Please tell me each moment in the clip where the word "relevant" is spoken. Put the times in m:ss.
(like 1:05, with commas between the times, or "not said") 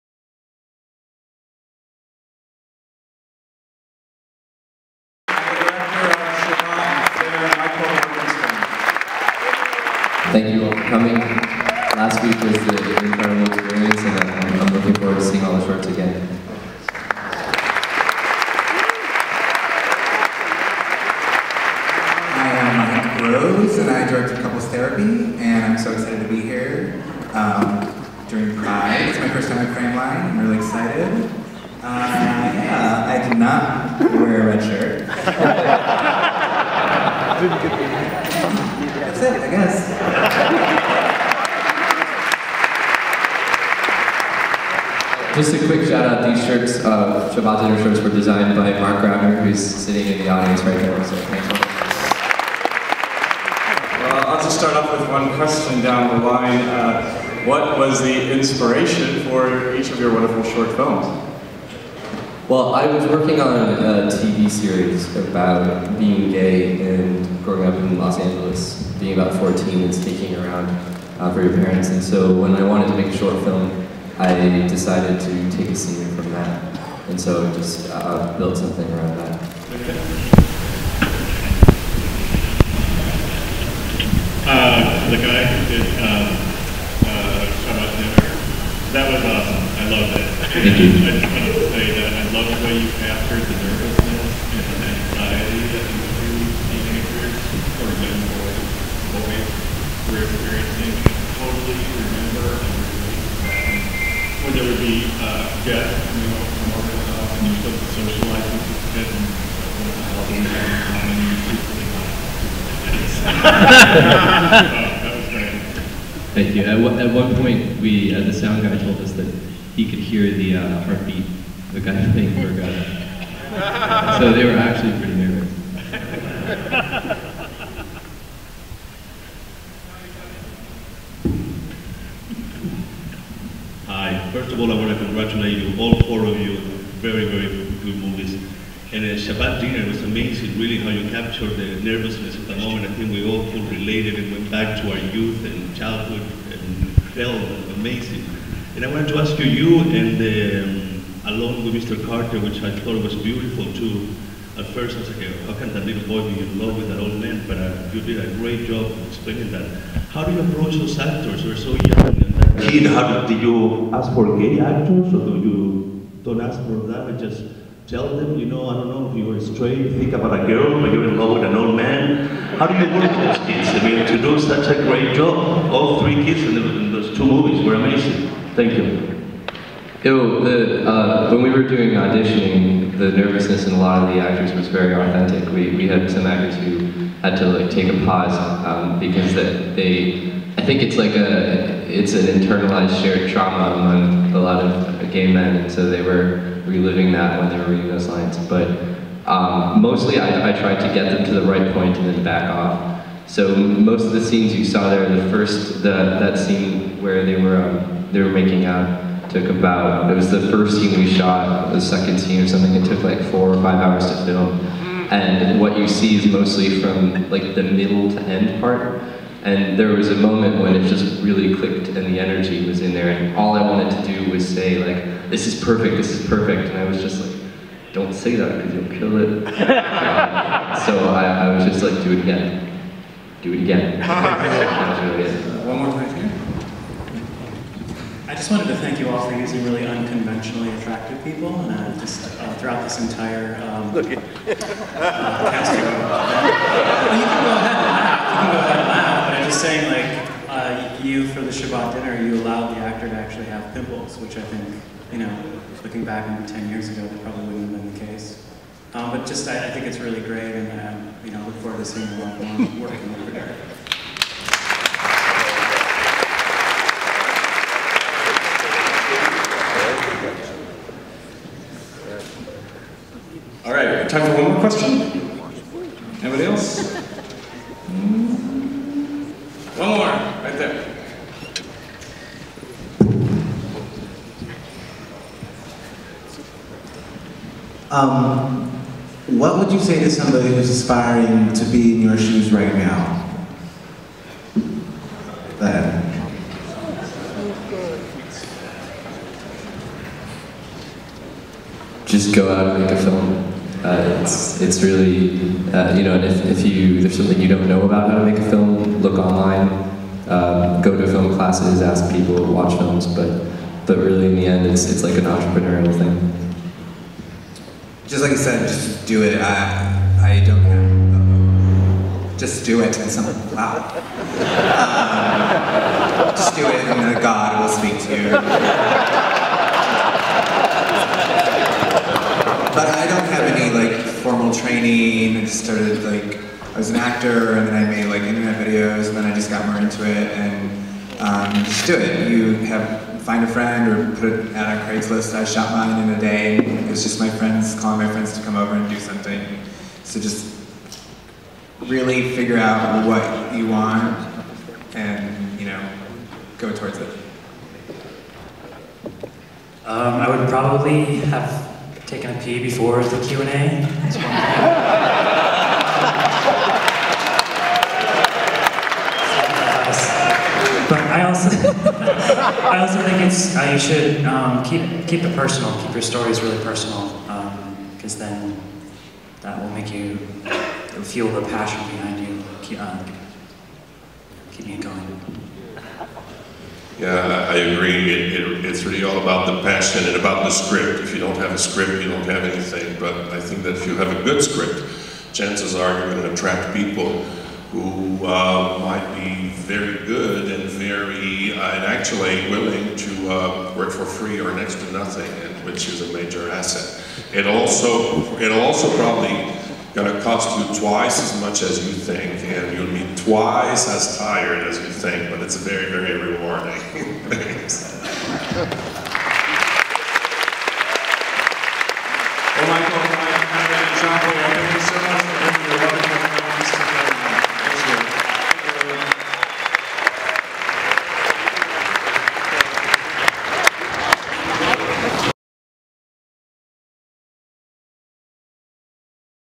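not said.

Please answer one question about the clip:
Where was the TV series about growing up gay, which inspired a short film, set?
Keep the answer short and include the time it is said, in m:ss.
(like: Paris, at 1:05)
Los Angeles, at 1:07.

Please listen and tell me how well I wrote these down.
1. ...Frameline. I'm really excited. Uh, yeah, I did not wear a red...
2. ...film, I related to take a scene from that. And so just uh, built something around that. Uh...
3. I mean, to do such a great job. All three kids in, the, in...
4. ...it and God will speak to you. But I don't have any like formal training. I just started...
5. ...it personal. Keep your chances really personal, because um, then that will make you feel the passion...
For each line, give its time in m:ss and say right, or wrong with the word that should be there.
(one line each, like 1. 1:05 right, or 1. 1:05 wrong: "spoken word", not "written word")
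1. 0:29 right
2. 1:13 wrong: "decided", not "related"
3. 2:53 right
4. 5:26 right
5. 6:15 wrong: "stories", not "chances".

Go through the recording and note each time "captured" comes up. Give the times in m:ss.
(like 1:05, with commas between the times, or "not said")
1:32, 2:21.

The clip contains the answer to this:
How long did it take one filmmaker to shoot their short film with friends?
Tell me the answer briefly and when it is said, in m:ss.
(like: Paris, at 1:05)
a day, at 5:46.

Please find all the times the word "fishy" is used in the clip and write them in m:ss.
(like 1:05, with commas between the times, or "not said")
not said.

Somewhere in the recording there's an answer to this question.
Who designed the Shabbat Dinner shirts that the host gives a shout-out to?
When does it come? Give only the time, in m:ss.
0:48.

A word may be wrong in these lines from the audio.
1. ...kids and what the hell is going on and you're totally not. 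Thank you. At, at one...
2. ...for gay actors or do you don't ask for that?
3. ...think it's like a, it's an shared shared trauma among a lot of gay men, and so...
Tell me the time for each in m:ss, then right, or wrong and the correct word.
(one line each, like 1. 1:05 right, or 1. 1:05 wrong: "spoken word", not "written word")
1. 1:48 wrong: "secretly", not "totally"
2. 2:44 right
3. 3:10 wrong: "internalized", not "shared".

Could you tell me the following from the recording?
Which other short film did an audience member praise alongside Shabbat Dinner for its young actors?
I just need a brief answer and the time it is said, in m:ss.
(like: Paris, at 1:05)
Mr. Carter, at 2:31.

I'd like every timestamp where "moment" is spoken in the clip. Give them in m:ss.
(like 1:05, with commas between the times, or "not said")
2:22, 3:40.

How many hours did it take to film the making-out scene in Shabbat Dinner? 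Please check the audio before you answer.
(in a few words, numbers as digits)
4 or 5 hours.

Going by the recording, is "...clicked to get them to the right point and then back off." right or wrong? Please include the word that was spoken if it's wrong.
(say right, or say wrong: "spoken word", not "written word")
wrong: "tried", not "clicked".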